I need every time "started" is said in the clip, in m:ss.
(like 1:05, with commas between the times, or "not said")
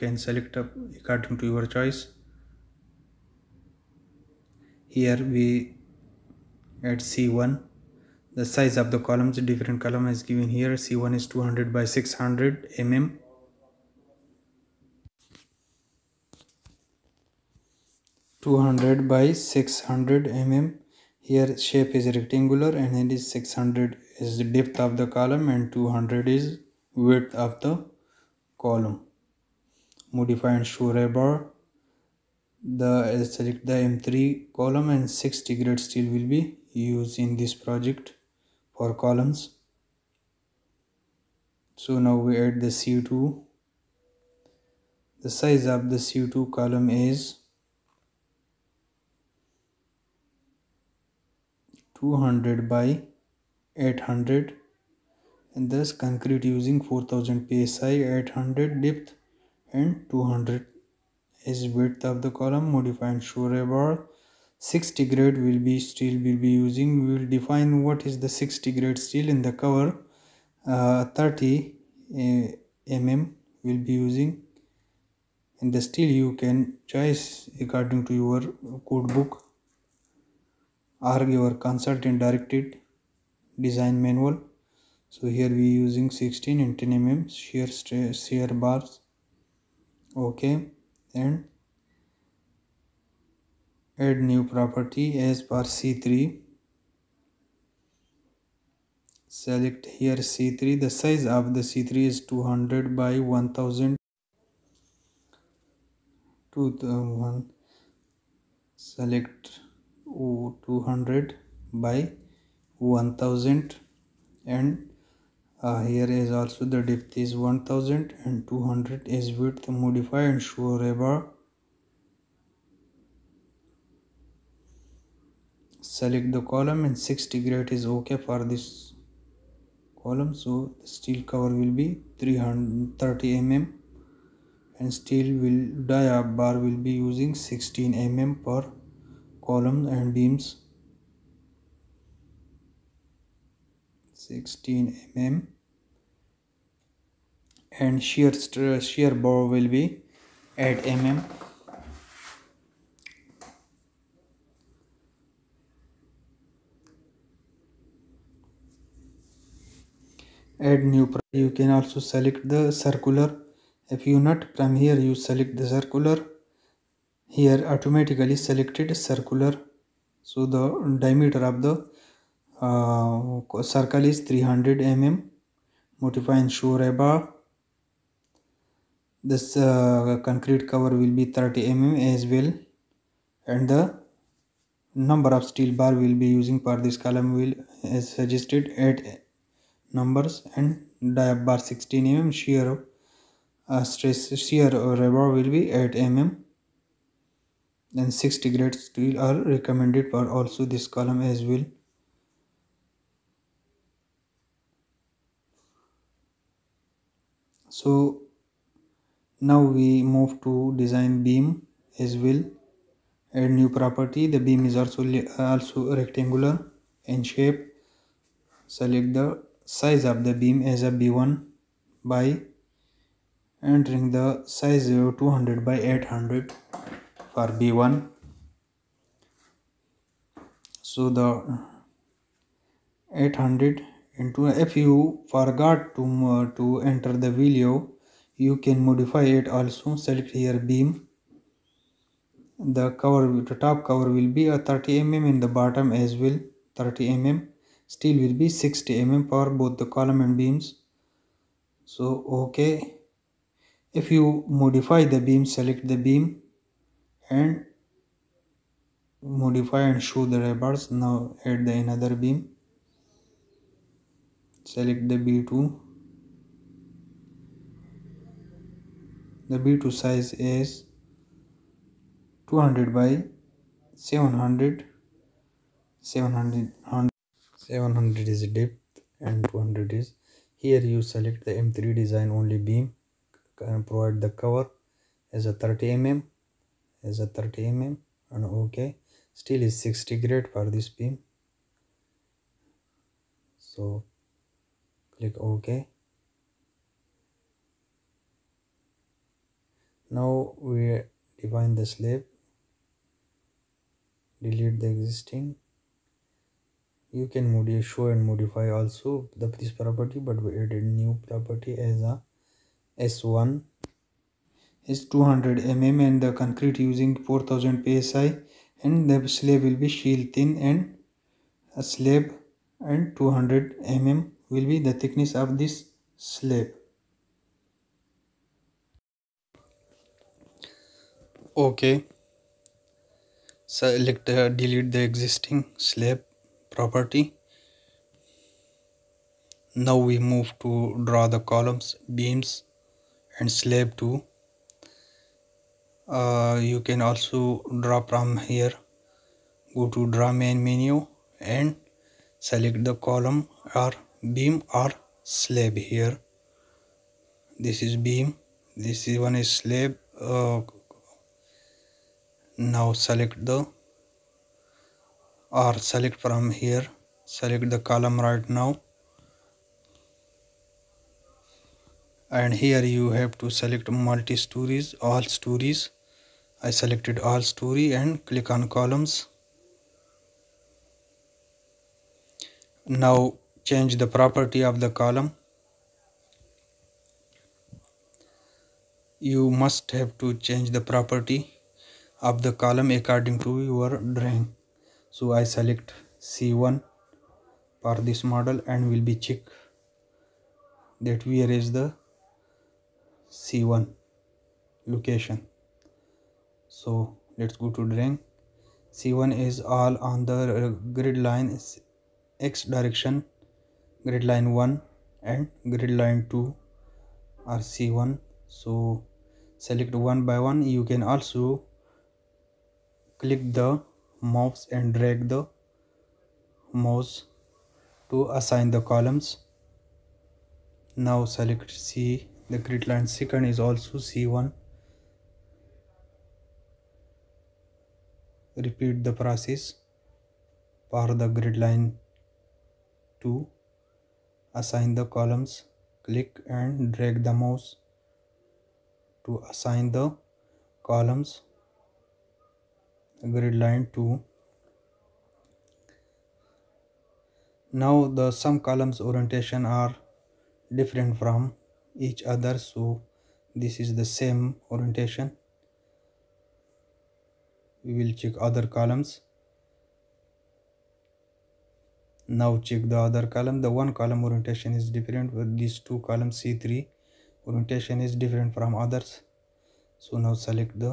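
not said.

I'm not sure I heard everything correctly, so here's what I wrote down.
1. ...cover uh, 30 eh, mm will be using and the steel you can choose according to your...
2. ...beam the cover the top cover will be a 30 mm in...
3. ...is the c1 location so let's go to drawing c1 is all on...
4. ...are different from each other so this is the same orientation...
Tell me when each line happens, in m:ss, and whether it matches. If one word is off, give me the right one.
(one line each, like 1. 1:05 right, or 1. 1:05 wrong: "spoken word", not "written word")
1. 1:09 right
2. 4:00 right
3. 6:41 right
4. 7:39 right.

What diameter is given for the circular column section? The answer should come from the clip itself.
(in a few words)
300 mm.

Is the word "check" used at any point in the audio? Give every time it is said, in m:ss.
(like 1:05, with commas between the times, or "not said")
6:39, 7:48, 7:52.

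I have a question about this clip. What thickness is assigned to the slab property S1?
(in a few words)
200 mm.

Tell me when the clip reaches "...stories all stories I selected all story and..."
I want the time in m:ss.
6:14.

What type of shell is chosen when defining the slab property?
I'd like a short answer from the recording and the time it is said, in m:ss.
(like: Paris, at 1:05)
shell thin, at 5:19.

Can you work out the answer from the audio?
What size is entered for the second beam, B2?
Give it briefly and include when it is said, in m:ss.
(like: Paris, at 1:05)
200 by 700, at 4:32.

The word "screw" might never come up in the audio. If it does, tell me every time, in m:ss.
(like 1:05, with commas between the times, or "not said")
not said.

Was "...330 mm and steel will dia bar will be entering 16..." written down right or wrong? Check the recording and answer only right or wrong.
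wrong.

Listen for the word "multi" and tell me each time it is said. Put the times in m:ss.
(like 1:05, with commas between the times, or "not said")
6:13.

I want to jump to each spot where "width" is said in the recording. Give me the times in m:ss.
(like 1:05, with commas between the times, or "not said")
0:27, 1:01, 1:59.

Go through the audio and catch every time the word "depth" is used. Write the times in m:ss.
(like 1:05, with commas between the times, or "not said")
0:24, 0:58, 1:56, 4:38.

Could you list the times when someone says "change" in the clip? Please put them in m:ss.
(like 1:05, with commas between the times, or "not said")
6:23, 6:30.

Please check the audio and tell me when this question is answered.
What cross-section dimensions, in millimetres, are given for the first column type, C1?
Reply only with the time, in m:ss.
0:11.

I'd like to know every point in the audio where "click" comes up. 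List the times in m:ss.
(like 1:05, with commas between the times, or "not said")
4:55, 6:18, 7:03, 7:26.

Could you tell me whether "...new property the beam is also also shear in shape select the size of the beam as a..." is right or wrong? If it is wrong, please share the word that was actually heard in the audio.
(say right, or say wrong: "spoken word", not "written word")
wrong: "rectangular", not "shear".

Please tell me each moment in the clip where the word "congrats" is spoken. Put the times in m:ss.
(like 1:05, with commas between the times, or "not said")
not said.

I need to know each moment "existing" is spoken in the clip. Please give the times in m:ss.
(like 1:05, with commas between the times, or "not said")
5:04, 5:35.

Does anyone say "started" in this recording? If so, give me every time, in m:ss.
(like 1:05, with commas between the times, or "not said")
not said.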